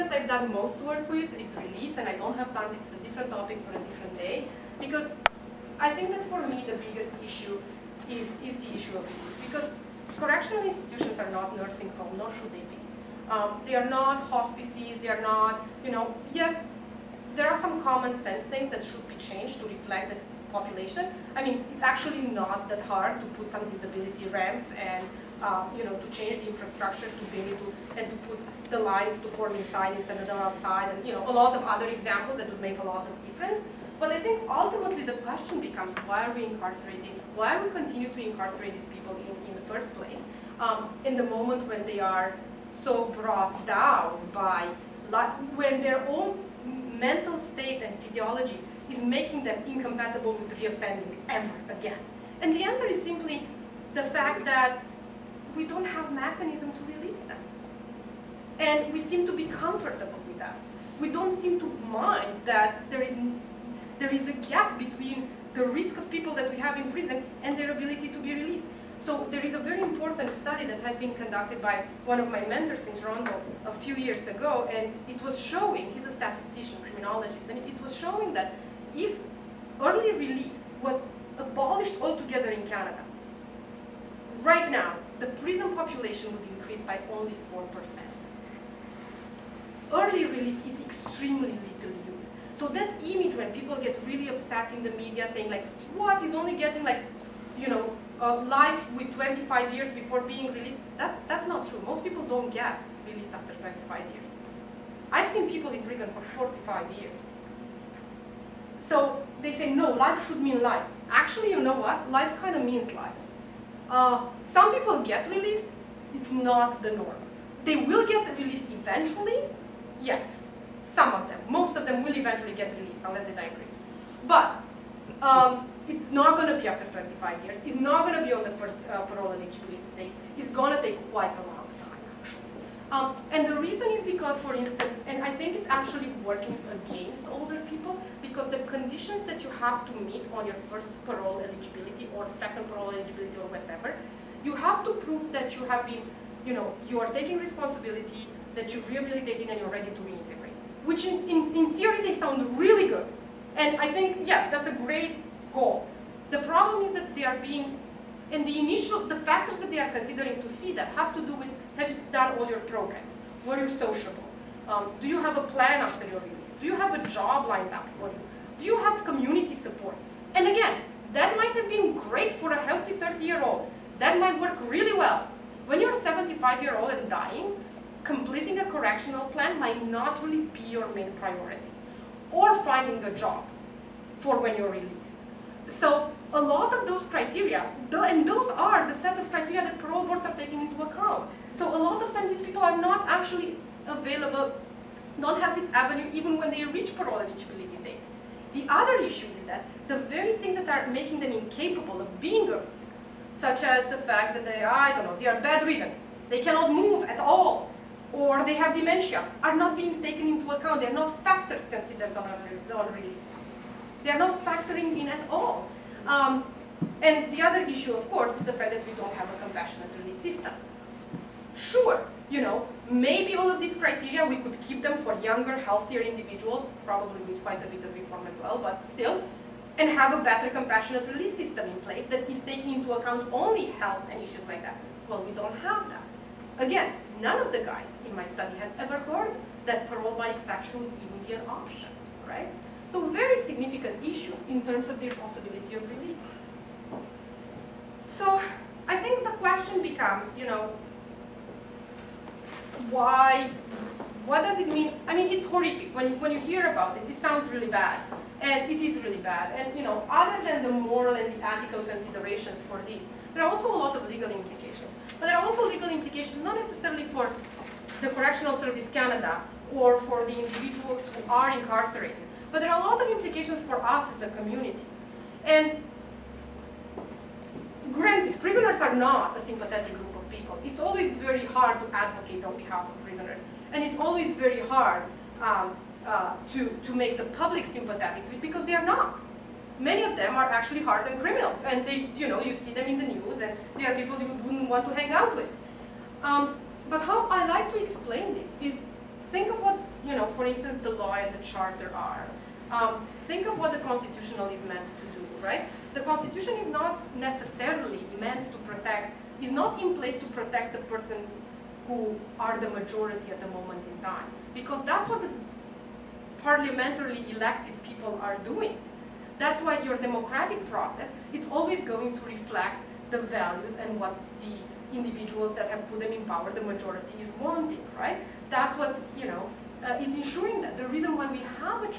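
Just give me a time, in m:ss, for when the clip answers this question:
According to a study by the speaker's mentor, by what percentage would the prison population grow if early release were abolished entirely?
1:27.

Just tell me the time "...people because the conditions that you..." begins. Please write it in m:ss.
2:17.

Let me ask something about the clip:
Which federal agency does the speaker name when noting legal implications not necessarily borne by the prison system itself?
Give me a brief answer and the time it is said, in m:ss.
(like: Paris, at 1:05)
Correctional Service Canada, at 4:28.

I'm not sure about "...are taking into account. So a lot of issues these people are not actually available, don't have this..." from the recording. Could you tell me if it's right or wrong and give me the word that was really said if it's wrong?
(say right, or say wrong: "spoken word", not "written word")
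wrong: "times", not "issues".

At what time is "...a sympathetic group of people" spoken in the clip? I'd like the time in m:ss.
4:39.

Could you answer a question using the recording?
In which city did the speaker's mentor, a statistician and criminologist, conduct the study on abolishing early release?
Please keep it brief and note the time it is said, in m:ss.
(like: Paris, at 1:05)
Toronto, at 1:12.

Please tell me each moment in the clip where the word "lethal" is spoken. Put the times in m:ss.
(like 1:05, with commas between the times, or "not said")
1:31.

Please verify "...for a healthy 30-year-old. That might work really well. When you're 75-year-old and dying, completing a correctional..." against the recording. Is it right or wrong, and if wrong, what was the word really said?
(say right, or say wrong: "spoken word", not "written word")
right.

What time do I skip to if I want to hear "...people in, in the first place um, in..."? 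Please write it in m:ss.
0:38.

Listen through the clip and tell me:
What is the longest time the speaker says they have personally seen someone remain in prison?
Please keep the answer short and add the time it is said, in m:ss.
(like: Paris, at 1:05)
45 years, at 1:46.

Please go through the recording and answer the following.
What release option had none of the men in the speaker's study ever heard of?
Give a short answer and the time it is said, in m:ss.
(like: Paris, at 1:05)
parole by exception, at 3:59.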